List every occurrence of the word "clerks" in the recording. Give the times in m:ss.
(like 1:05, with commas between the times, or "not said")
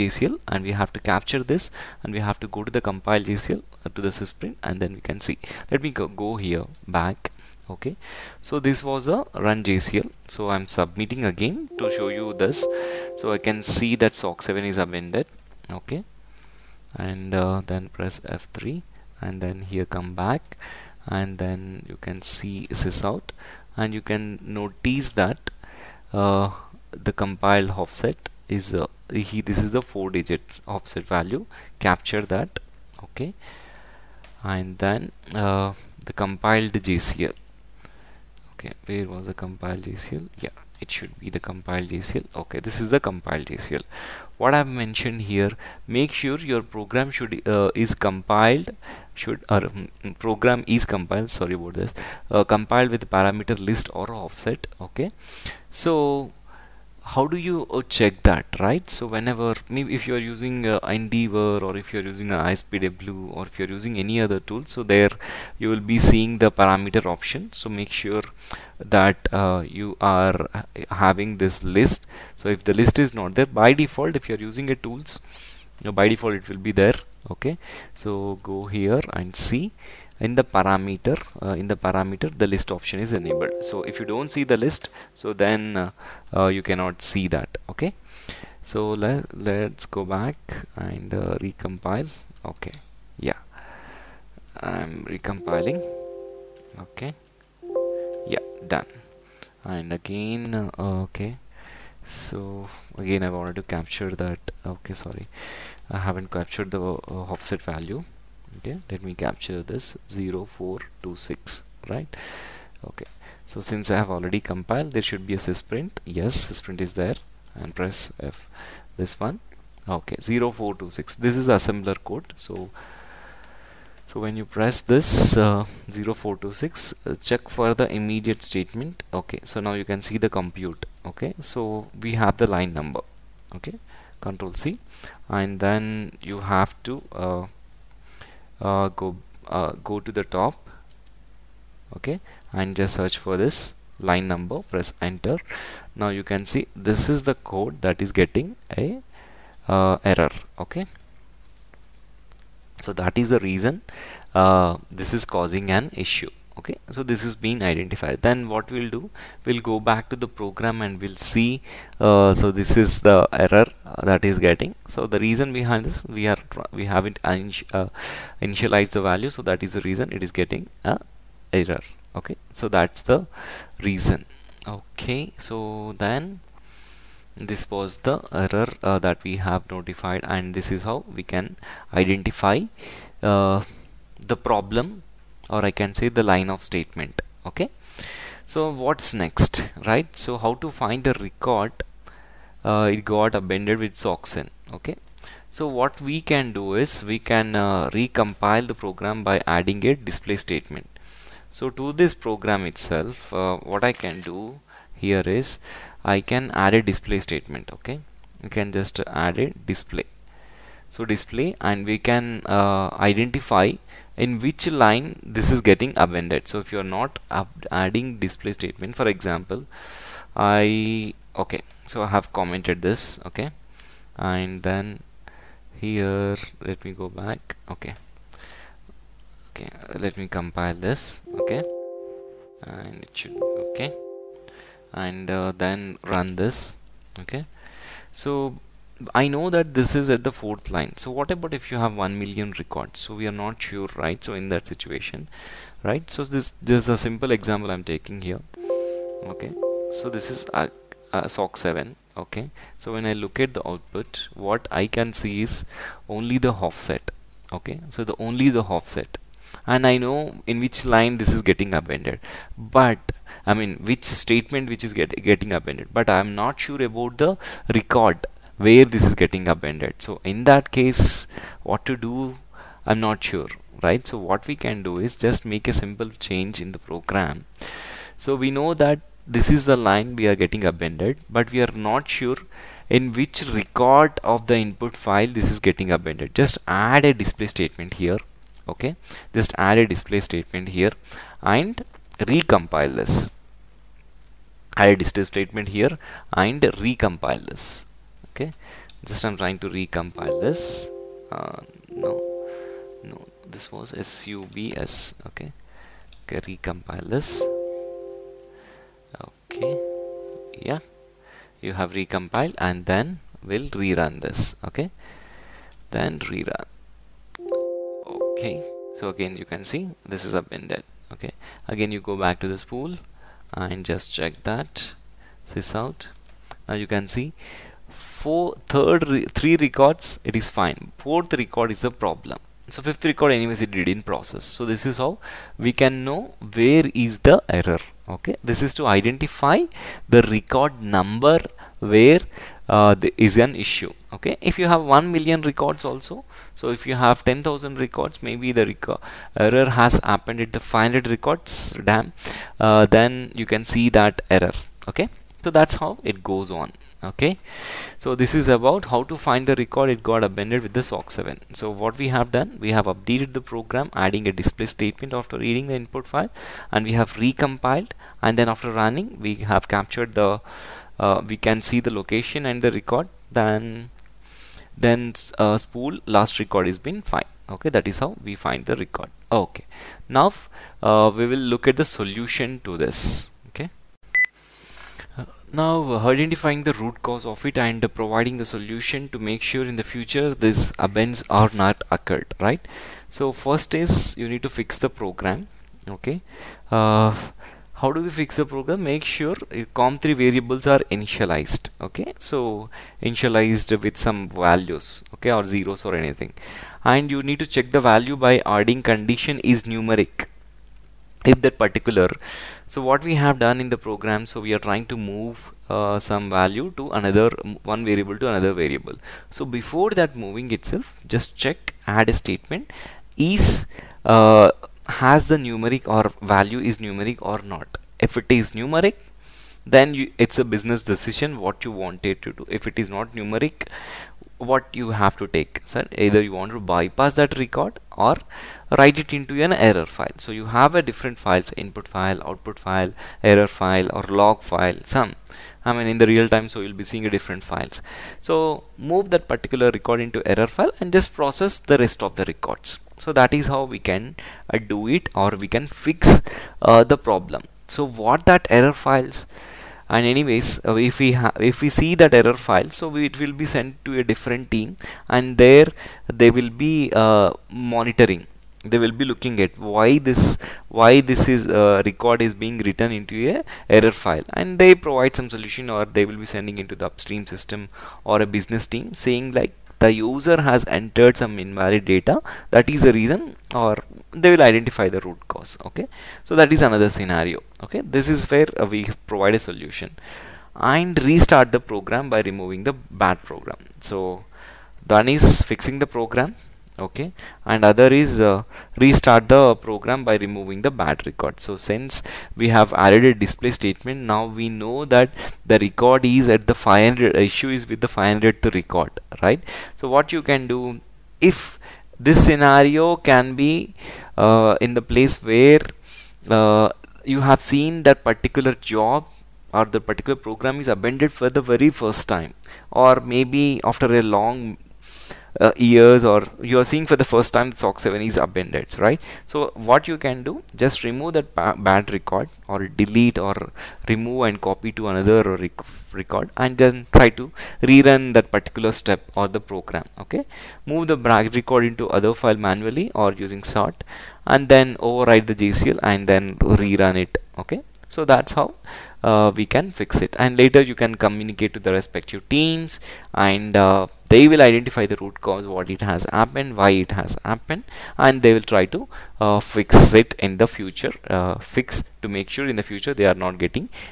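not said.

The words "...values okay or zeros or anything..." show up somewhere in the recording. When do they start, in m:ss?
6:44.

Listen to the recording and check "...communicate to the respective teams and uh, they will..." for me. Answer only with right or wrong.
right.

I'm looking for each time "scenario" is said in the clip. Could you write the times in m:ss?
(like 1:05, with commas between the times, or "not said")
8:06, 8:32.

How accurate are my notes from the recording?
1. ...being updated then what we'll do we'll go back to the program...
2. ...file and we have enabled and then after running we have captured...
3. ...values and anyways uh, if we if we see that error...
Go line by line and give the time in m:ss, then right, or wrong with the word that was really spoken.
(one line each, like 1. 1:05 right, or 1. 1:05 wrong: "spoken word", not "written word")
1. 2:37 wrong: "identified", not "updated"
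2. 6:06 wrong: "recompiled", not "enabled"
3. 7:38 wrong: "files", not "values".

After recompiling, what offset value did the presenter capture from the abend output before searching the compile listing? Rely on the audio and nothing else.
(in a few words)
0426.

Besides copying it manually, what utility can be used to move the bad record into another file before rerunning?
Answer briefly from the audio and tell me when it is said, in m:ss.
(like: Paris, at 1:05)
sort, at 9:03.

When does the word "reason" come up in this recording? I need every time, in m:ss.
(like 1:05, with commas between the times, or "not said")
2:33, 2:45, 2:49, 2:53, 8:02.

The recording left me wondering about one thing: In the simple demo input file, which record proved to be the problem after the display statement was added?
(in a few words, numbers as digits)
fourth record.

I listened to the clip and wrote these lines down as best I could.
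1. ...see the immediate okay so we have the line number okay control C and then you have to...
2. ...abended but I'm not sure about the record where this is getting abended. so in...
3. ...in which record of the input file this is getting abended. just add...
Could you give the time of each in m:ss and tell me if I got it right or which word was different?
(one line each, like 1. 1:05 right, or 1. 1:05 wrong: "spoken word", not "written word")
1. 2:10 wrong: "compute", not "immediate"
2. 4:25 right
3. 4:42 right.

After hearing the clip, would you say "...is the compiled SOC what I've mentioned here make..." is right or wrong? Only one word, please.
wrong.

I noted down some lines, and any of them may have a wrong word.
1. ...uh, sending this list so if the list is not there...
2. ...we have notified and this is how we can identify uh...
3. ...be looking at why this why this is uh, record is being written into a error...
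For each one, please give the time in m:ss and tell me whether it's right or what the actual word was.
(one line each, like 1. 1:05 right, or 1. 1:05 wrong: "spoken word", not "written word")
1. 1:10 wrong: "having", not "sending"
2. 2:59 right
3. 7:48 right.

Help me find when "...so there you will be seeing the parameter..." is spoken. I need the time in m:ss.
1:04.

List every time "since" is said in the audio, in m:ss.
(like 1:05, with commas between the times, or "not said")
1:53, 8:21.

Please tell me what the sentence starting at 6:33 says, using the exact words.
So first is you need to fix the program okay.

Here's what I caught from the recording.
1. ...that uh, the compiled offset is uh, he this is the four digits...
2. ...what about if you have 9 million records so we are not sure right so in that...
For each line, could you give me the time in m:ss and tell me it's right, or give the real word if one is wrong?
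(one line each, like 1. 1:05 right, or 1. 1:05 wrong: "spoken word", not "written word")
1. 0:25 right
2. 4:01 wrong: "1", not "9".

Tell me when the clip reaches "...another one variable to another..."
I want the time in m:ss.
6:56.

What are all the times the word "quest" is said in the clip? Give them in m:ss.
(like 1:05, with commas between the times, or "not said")
not said.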